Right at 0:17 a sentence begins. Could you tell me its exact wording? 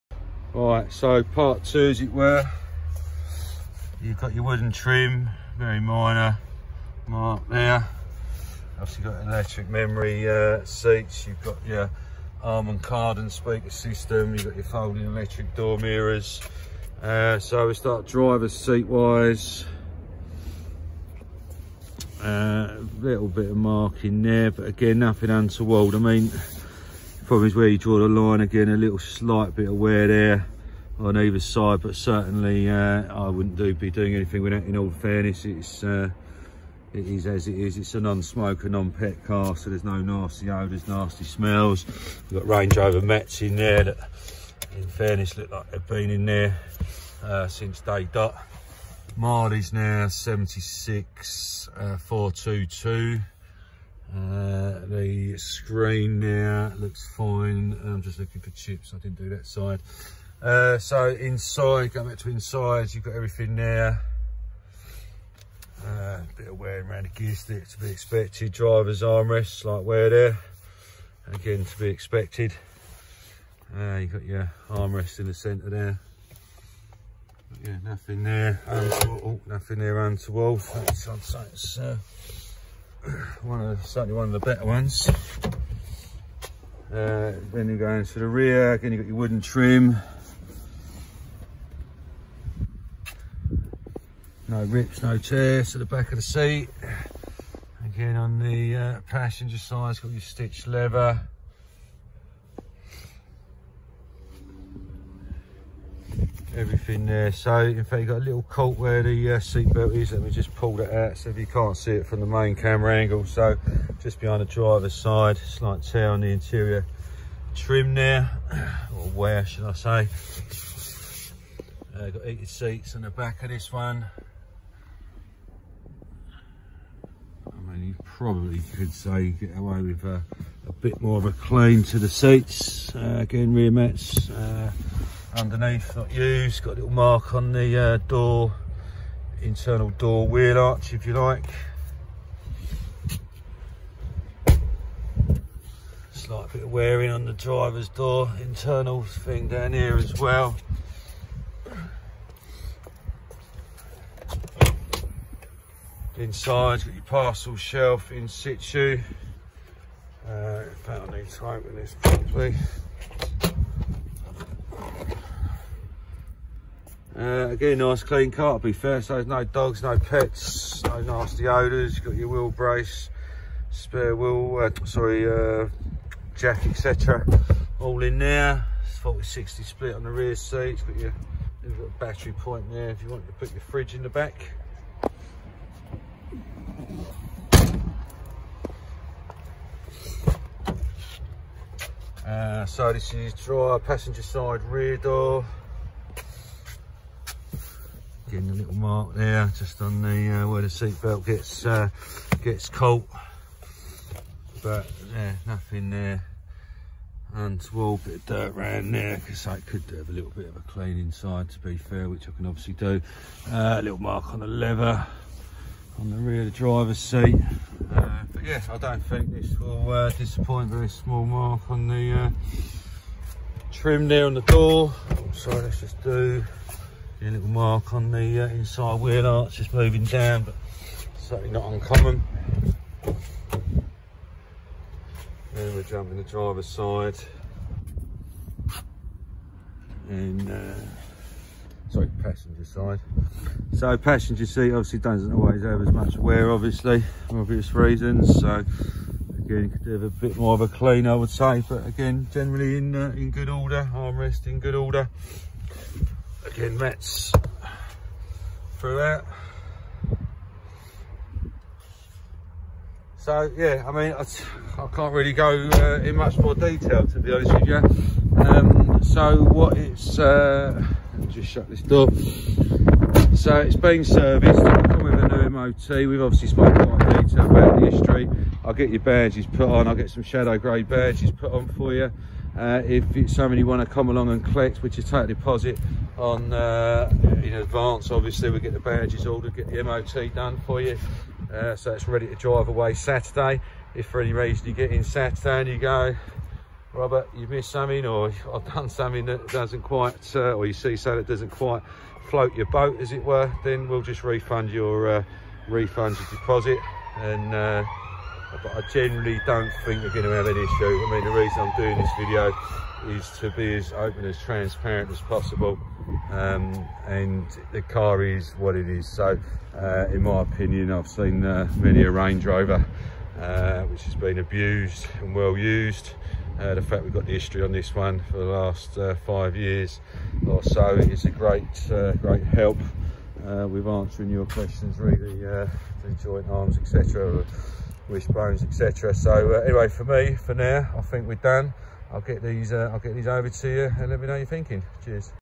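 Uh, so we start driver's seat wise.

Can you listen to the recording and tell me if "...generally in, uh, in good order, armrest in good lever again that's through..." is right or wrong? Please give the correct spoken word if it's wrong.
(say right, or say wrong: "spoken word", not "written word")
wrong: "order", not "lever".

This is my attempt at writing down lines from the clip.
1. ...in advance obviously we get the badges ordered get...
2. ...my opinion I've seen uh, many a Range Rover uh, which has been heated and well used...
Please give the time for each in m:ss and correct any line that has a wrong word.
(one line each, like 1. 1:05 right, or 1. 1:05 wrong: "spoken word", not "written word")
1. 4:47 right
2. 5:20 wrong: "abused", not "heated".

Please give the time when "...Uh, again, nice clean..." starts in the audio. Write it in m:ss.
2:47.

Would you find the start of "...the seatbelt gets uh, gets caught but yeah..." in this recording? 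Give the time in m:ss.
3:20.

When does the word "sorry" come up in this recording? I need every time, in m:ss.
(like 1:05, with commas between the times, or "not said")
2:54, 3:45, 4:01.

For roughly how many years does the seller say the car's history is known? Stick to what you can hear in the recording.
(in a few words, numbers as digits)
5 years.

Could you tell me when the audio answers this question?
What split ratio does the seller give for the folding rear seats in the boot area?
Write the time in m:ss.
2:58.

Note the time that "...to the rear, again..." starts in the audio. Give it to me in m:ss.
1:28.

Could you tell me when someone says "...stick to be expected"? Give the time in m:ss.
1:07.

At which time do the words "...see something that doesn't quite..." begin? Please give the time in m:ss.
5:00.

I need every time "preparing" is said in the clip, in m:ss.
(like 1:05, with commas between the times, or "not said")
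not said.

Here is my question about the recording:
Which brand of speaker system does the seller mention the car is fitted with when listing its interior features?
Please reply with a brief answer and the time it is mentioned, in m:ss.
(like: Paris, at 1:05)
Harman Kardon, at 0:12.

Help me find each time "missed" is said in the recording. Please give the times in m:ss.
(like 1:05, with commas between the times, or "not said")
4:57.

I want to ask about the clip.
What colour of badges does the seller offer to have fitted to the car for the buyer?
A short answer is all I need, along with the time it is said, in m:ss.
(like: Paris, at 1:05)
Shadow grey, at 4:40.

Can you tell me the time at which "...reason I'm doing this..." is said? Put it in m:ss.
5:11.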